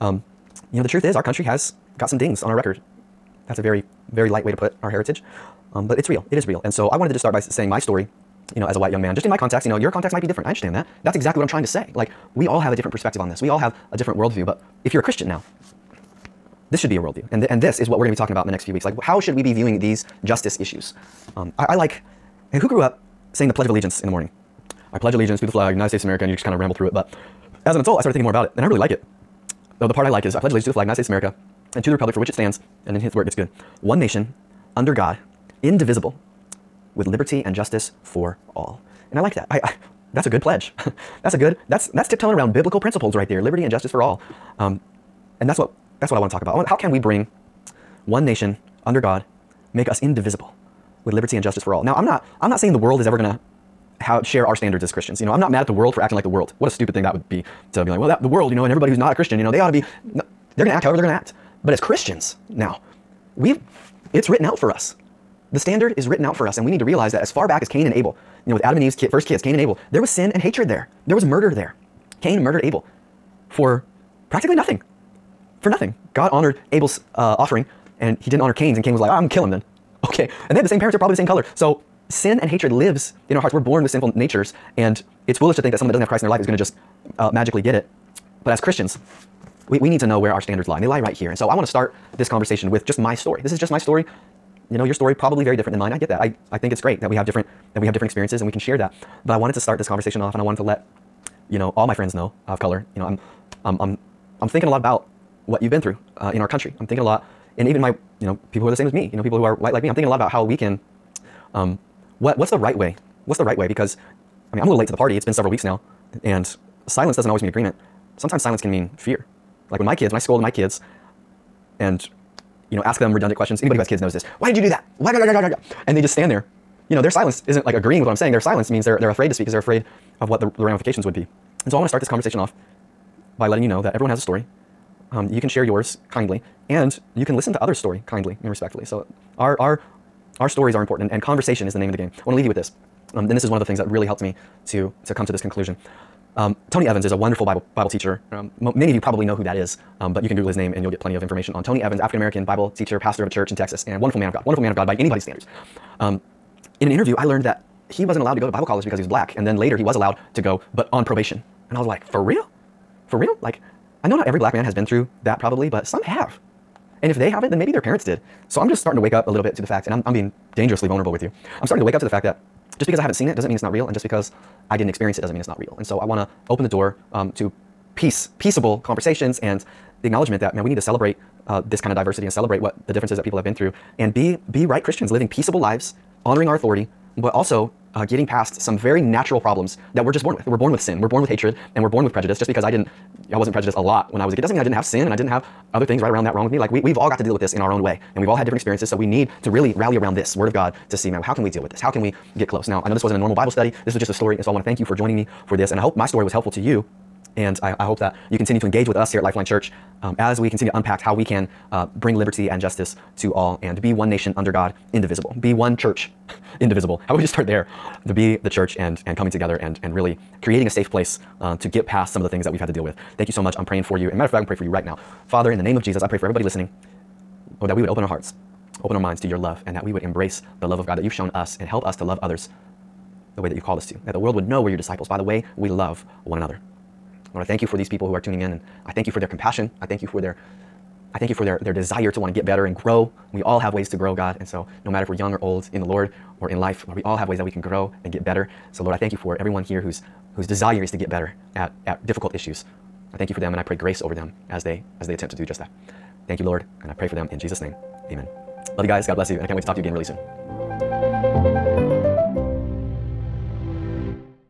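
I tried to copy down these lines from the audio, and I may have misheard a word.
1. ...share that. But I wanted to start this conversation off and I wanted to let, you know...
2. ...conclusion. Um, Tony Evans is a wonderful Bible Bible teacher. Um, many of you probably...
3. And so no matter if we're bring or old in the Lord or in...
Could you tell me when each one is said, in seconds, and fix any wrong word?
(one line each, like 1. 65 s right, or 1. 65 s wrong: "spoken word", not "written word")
1. 98 s right
2. 145 s right
3. 244 s wrong: "young", not "bring".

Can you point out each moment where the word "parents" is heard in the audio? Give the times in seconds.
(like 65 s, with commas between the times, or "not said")
80 s, 167 s.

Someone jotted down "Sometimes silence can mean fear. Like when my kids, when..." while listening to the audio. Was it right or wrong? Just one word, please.
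right.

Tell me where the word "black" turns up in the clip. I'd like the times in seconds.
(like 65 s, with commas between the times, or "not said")
159 s, 164 s.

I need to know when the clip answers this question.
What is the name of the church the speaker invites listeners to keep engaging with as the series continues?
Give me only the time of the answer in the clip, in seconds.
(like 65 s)
209 s.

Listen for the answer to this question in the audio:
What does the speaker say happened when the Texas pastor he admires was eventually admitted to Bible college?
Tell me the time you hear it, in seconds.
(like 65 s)
160 s.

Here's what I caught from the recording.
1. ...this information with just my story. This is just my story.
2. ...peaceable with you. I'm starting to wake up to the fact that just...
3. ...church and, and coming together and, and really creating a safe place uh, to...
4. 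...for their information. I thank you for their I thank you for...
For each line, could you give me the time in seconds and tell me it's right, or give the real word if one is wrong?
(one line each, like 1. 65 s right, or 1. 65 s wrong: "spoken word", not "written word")
1. 92 s wrong: "conversation", not "information"
2. 170 s wrong: "vulnerable", not "peaceable"
3. 218 s right
4. 239 s wrong: "compassion", not "information".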